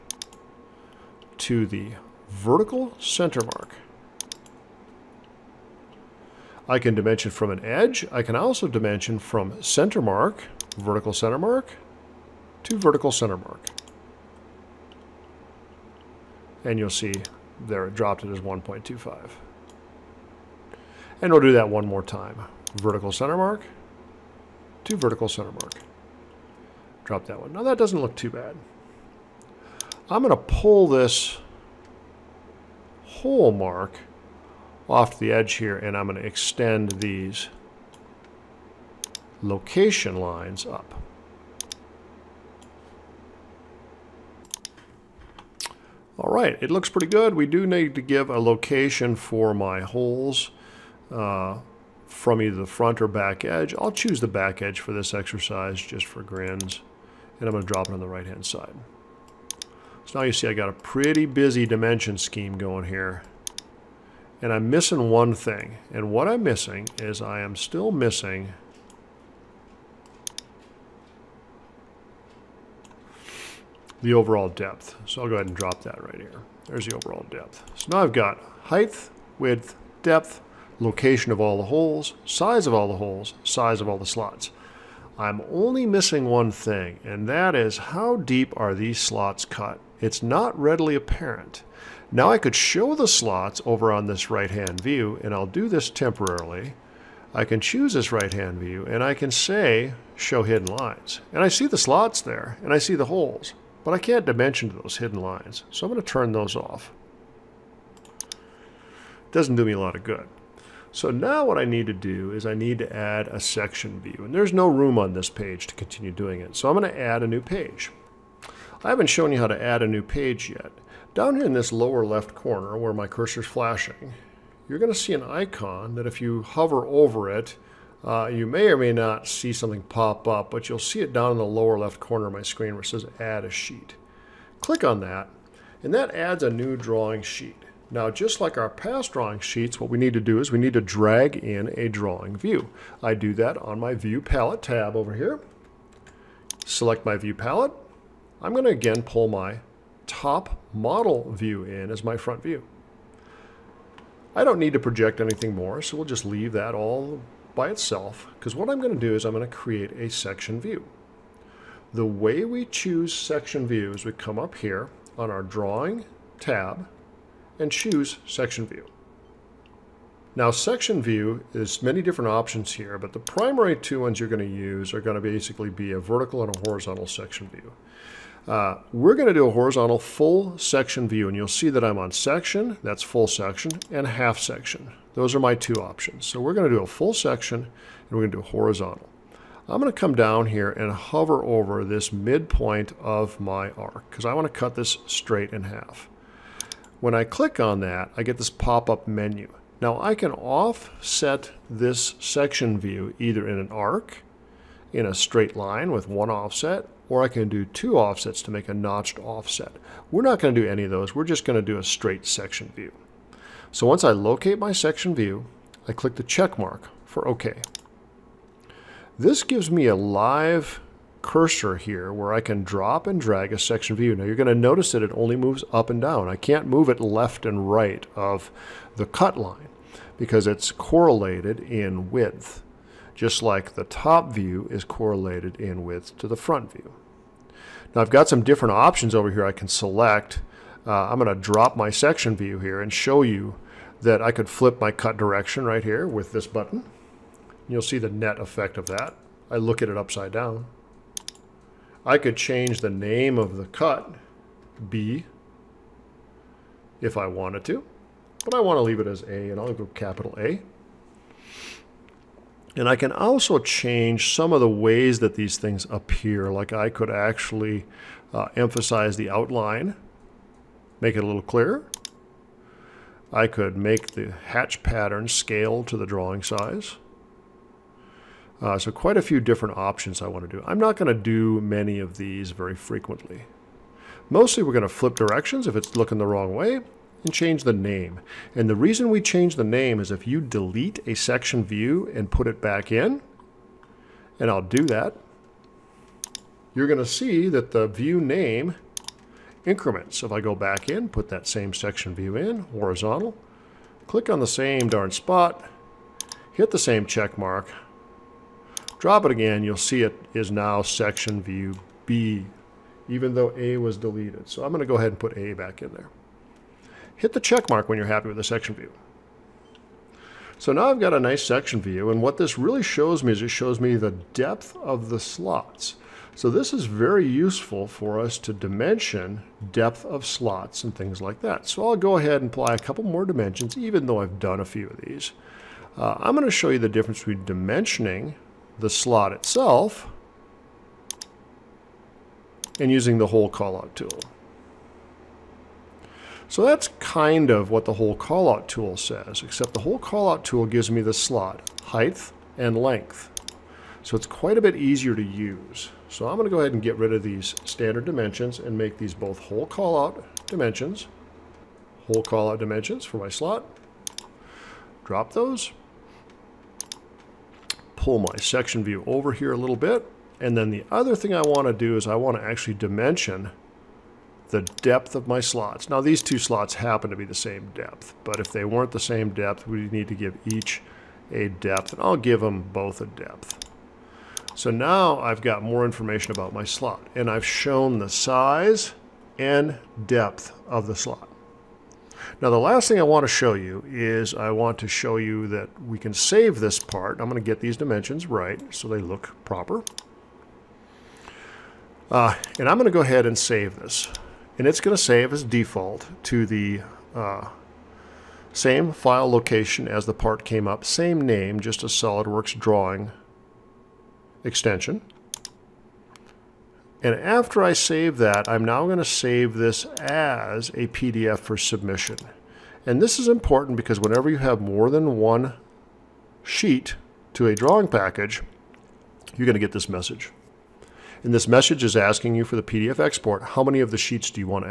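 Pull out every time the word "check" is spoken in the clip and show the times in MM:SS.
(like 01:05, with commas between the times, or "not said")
03:36, 05:07, 05:17.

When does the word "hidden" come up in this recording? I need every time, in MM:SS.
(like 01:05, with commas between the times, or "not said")
01:40, 01:44.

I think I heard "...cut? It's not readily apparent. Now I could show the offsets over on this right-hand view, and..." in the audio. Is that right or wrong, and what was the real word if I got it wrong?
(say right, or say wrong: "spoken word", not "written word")
wrong: "slots", not "offsets".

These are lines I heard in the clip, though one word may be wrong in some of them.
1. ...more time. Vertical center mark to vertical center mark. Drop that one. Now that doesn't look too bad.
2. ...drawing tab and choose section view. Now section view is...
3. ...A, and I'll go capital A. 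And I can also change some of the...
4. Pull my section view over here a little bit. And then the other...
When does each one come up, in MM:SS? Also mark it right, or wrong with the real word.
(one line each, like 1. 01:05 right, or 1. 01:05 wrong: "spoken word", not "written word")
1. 00:21 right
2. 02:45 right
3. 04:19 right
4. 06:07 right.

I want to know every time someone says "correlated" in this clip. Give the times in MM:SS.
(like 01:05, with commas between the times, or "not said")
03:50, 03:54.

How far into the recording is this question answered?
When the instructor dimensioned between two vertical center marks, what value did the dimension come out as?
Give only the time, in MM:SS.
00:18.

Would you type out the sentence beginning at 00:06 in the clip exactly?
I can dimension from an edge.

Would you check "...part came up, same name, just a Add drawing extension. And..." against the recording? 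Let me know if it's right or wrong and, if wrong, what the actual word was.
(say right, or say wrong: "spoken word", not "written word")
wrong: "SOLIDWORKS", not "Add".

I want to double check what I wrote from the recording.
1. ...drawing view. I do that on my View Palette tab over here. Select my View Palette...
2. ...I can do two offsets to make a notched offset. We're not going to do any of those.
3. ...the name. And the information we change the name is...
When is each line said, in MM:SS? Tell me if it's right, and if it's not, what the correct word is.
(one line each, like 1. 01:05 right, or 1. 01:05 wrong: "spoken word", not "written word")
1. 02:21 right
2. 03:27 right
3. 04:47 wrong: "reason", not "information".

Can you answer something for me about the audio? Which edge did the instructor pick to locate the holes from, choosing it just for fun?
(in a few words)
the back edge.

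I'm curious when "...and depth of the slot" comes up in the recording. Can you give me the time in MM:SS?
06:29.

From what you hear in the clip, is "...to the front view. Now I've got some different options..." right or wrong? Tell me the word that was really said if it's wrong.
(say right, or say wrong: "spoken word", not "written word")
right.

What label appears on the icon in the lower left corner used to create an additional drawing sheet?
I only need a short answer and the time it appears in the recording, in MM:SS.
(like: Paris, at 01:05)
Add a Sheet, at 02:13.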